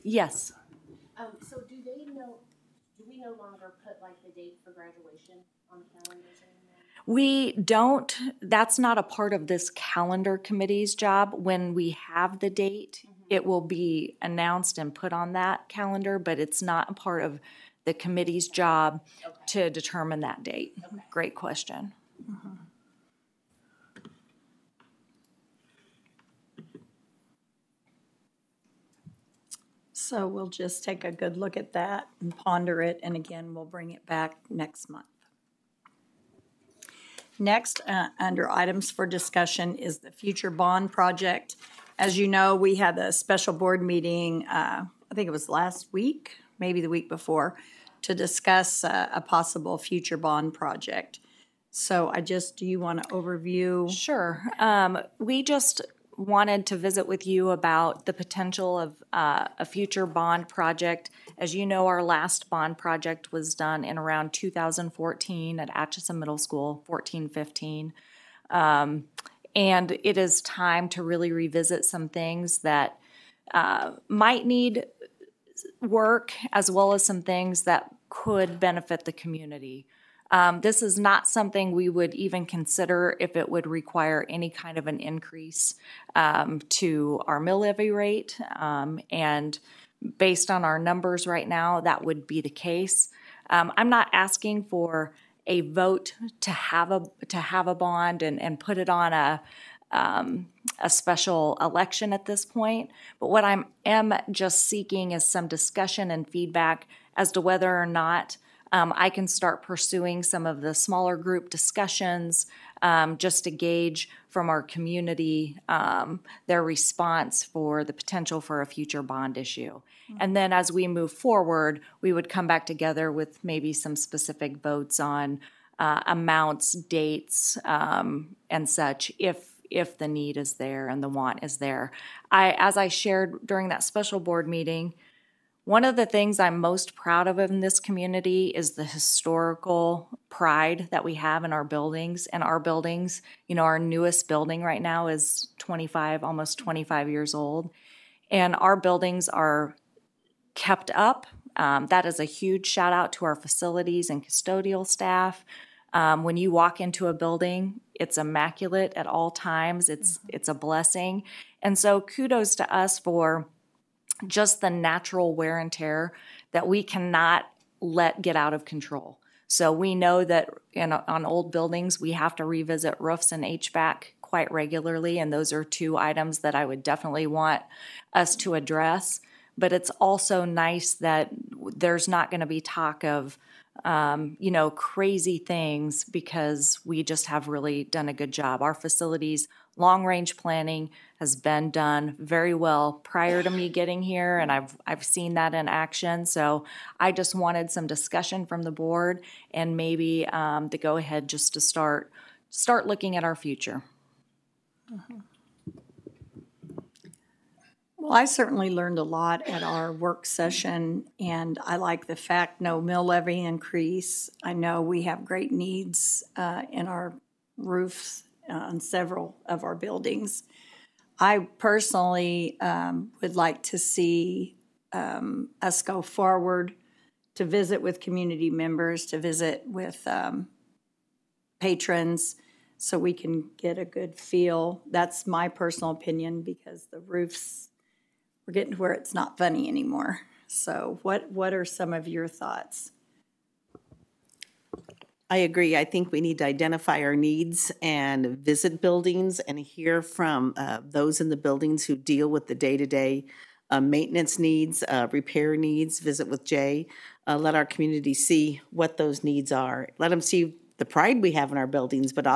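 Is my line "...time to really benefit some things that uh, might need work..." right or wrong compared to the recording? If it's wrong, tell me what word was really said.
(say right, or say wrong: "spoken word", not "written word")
wrong: "revisit", not "benefit".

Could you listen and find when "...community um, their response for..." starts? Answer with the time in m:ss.
1:54.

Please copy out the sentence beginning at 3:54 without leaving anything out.
That's my personal opinion because the roofs we're getting to where it's not funny anymore.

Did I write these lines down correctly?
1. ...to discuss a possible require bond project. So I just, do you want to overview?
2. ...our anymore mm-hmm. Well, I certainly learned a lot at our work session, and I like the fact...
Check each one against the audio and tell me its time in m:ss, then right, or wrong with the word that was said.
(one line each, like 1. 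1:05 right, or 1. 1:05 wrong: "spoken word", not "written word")
1. 0:48 wrong: "future", not "require"
2. 3:23 wrong: "future", not "anymore".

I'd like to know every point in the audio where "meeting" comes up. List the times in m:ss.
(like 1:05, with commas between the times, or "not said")
0:43, 2:14.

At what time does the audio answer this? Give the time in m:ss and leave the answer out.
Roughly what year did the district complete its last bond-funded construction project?
1:04.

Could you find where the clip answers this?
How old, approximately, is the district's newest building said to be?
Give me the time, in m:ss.
2:26.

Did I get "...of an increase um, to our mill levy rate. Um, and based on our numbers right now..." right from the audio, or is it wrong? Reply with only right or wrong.
right.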